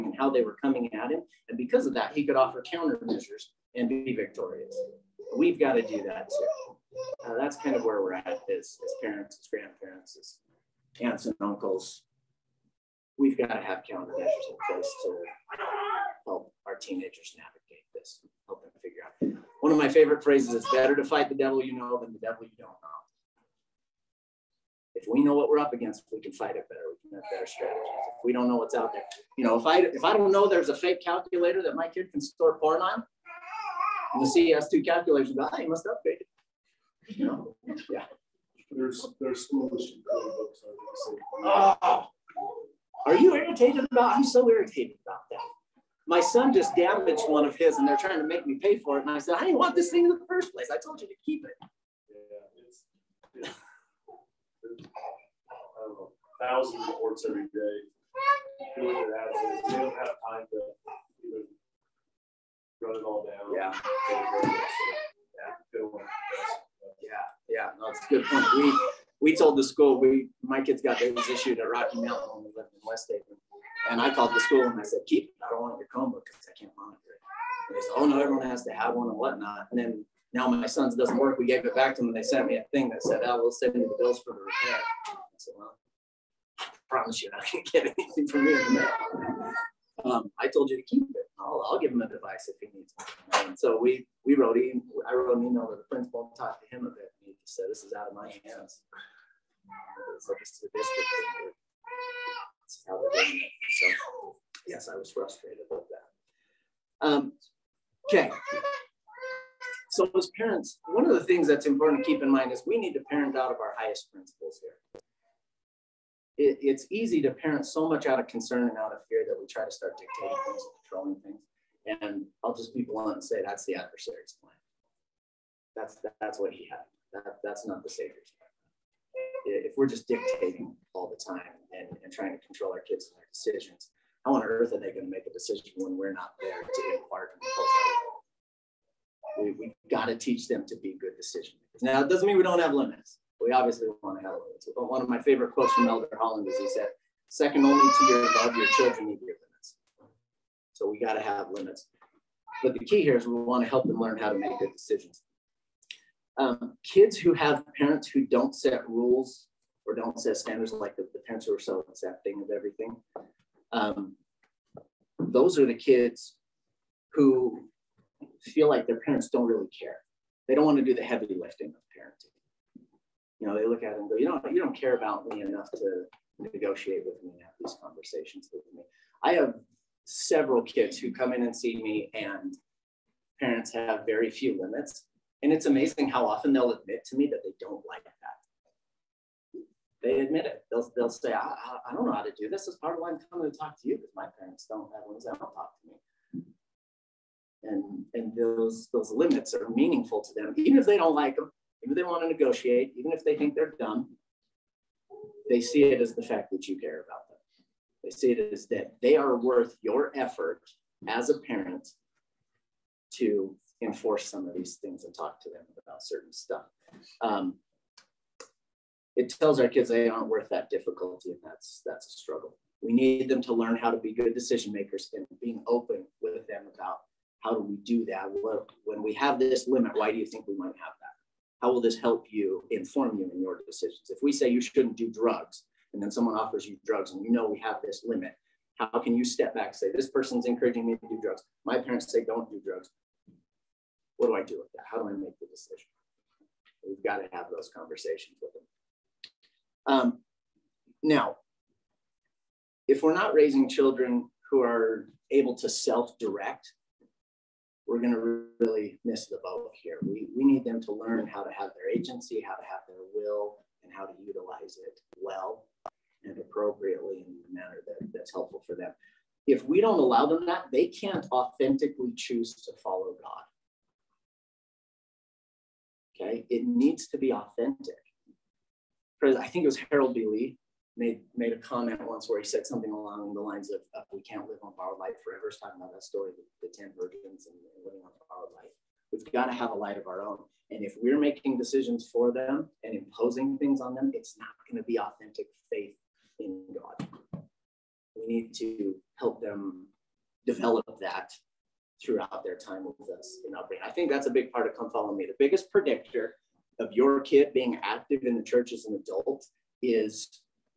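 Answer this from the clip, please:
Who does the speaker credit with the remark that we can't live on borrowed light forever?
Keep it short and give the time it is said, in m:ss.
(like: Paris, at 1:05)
Harold B. Lee, at 4:39.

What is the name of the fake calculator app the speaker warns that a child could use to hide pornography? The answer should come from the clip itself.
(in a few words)
CES2 calculator.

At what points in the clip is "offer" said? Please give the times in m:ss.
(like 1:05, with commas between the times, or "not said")
0:02, 3:56.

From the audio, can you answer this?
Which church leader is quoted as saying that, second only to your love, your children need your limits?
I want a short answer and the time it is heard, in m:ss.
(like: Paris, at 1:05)
Elder Holland, at 2:25.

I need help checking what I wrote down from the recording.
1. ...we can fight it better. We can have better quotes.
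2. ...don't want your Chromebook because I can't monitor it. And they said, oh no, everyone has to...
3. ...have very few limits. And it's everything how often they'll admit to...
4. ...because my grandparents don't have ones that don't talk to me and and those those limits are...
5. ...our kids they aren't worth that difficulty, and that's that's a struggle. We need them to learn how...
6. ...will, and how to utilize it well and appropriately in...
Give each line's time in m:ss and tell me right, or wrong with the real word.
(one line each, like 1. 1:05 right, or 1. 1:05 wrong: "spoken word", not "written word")
1. 0:26 wrong: "strategies", not "quotes"
2. 1:15 right
3. 3:03 wrong: "amazing", not "everything"
4. 3:13 wrong: "parents", not "grandparents"
5. 3:39 right
6. 4:23 right.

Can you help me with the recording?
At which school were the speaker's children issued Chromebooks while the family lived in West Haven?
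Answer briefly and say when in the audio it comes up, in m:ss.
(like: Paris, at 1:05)
Rocky Mountain, at 1:11.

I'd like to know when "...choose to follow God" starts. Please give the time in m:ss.
4:32.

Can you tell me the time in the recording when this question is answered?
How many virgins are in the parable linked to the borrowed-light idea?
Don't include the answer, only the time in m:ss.
4:46.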